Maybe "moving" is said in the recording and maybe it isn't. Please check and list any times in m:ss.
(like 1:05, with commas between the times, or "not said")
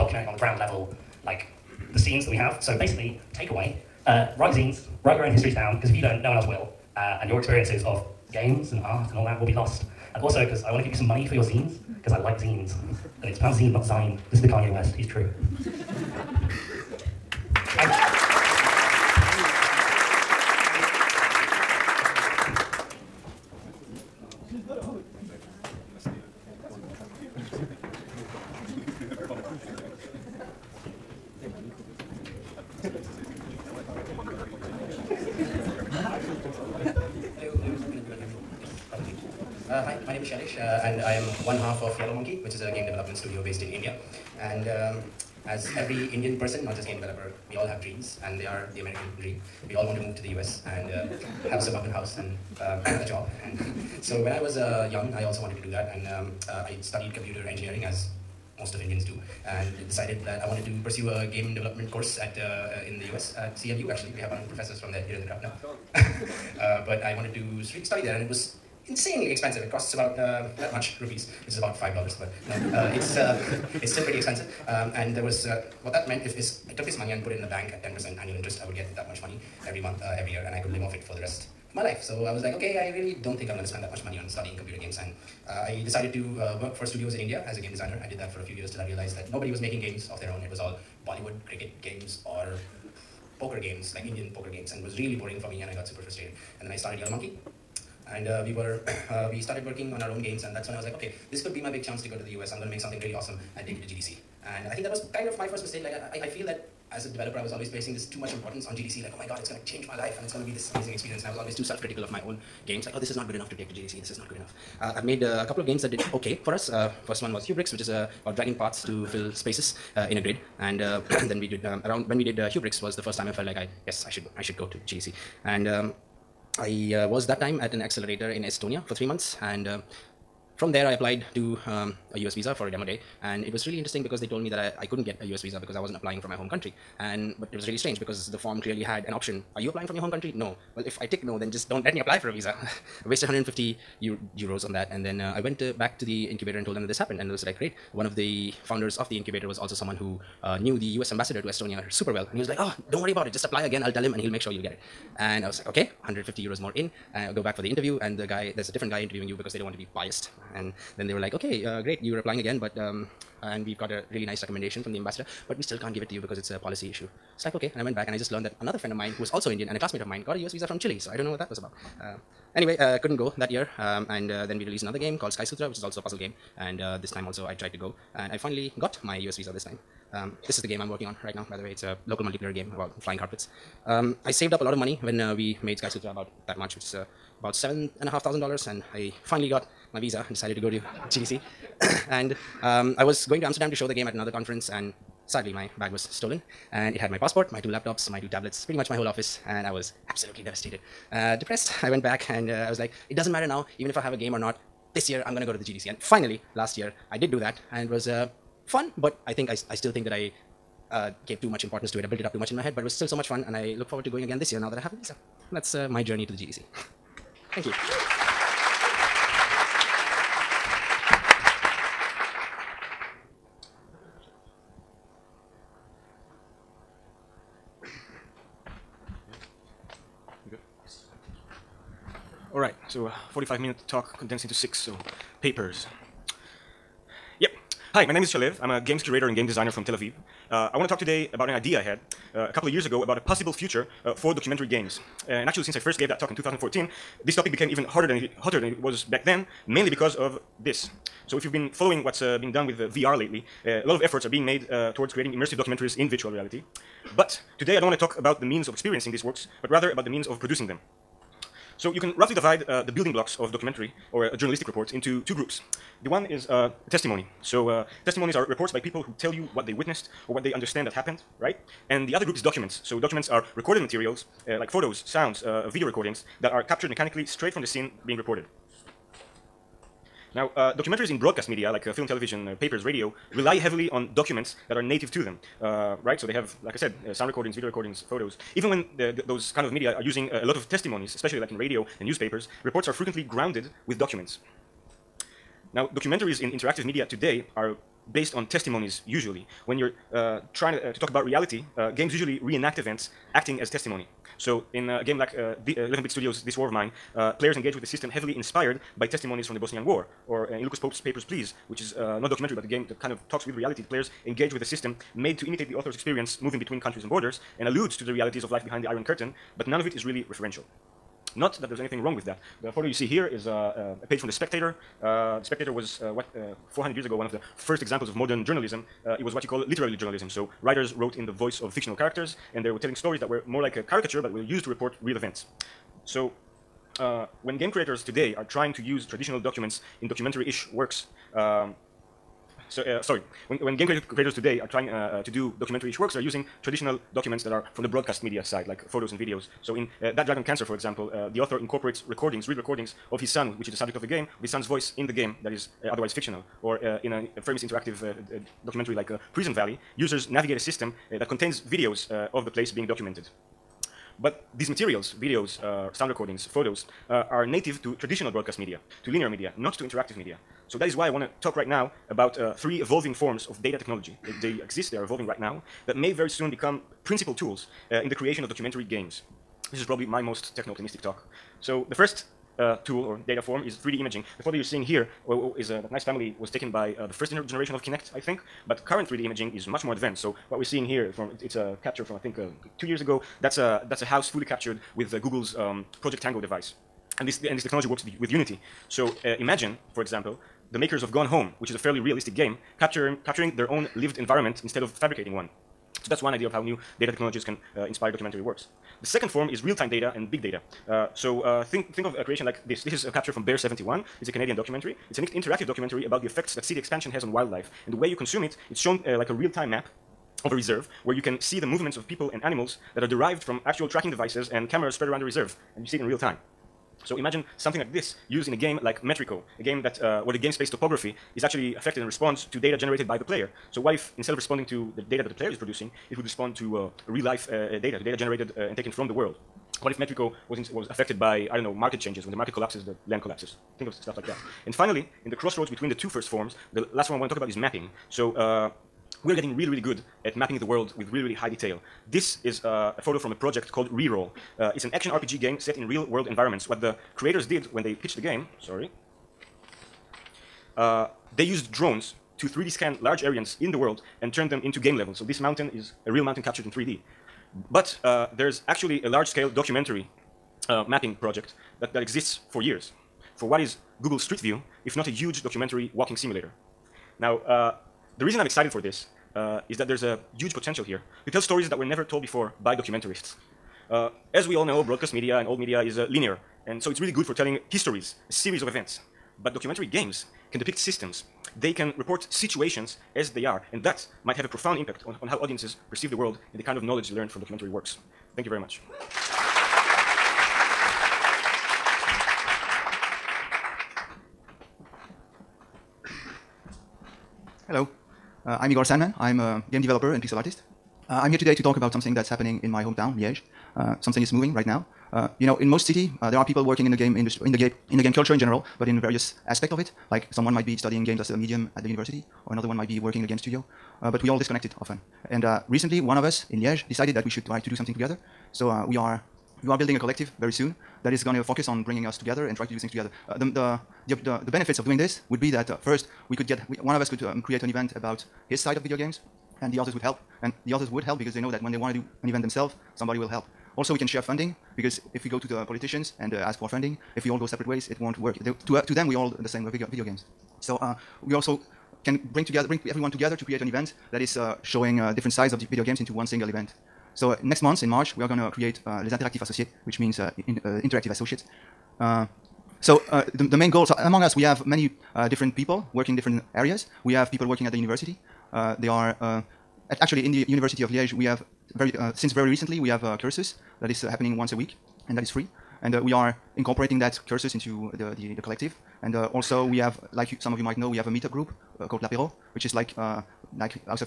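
5:16, 8:34.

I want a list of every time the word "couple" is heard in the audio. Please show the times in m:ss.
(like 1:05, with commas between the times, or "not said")
1:55, 4:02.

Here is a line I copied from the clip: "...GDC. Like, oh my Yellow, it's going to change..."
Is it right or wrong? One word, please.
wrong.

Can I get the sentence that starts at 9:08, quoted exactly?
They, to, uh, to them, we all the same.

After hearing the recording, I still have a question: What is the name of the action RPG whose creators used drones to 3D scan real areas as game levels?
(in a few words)
Reroll.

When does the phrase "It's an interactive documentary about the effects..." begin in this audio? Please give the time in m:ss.
6:55.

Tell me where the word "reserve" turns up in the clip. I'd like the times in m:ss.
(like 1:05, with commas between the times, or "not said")
7:00, 7:05.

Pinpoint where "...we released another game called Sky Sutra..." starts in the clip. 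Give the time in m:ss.
2:54.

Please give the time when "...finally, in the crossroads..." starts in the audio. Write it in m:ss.
7:24.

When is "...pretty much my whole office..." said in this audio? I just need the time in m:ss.
3:18.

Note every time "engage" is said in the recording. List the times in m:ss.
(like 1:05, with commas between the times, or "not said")
5:07, 5:14.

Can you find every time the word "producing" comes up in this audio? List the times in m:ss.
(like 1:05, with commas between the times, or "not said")
4:20, 7:15.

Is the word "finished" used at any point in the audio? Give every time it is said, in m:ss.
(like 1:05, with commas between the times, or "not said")
not said.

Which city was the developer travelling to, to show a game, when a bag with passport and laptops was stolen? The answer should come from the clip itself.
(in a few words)
Amsterdam.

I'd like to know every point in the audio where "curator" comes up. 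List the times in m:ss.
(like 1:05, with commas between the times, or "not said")
3:59.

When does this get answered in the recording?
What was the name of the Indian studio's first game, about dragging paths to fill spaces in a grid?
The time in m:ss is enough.
1:57.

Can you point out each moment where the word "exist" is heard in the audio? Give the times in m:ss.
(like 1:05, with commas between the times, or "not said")
6:14, 7:52.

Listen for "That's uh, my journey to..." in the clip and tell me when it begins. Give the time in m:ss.
3:35.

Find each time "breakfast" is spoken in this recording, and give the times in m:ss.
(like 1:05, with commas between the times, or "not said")
not said.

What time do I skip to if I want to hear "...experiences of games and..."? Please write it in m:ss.
0:07.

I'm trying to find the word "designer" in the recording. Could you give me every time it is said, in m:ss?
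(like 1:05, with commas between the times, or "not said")
1:27, 3:59.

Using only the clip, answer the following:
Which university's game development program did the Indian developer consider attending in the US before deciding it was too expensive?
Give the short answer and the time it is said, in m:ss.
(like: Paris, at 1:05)
CMU, at 1:03.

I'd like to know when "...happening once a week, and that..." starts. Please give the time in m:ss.
9:34.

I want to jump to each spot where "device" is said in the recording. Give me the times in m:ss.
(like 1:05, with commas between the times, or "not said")
6:36, 7:04.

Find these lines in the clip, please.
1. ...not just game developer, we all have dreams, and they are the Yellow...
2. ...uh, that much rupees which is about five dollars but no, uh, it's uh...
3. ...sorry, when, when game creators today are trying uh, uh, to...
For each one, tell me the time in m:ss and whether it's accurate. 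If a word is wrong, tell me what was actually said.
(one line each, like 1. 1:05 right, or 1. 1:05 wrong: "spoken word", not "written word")
1. 0:46 wrong: "American", not "Yellow"
2. 1:10 right
3. 5:43 right.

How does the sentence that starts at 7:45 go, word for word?
So this mountain is a real mountain captured in 3D.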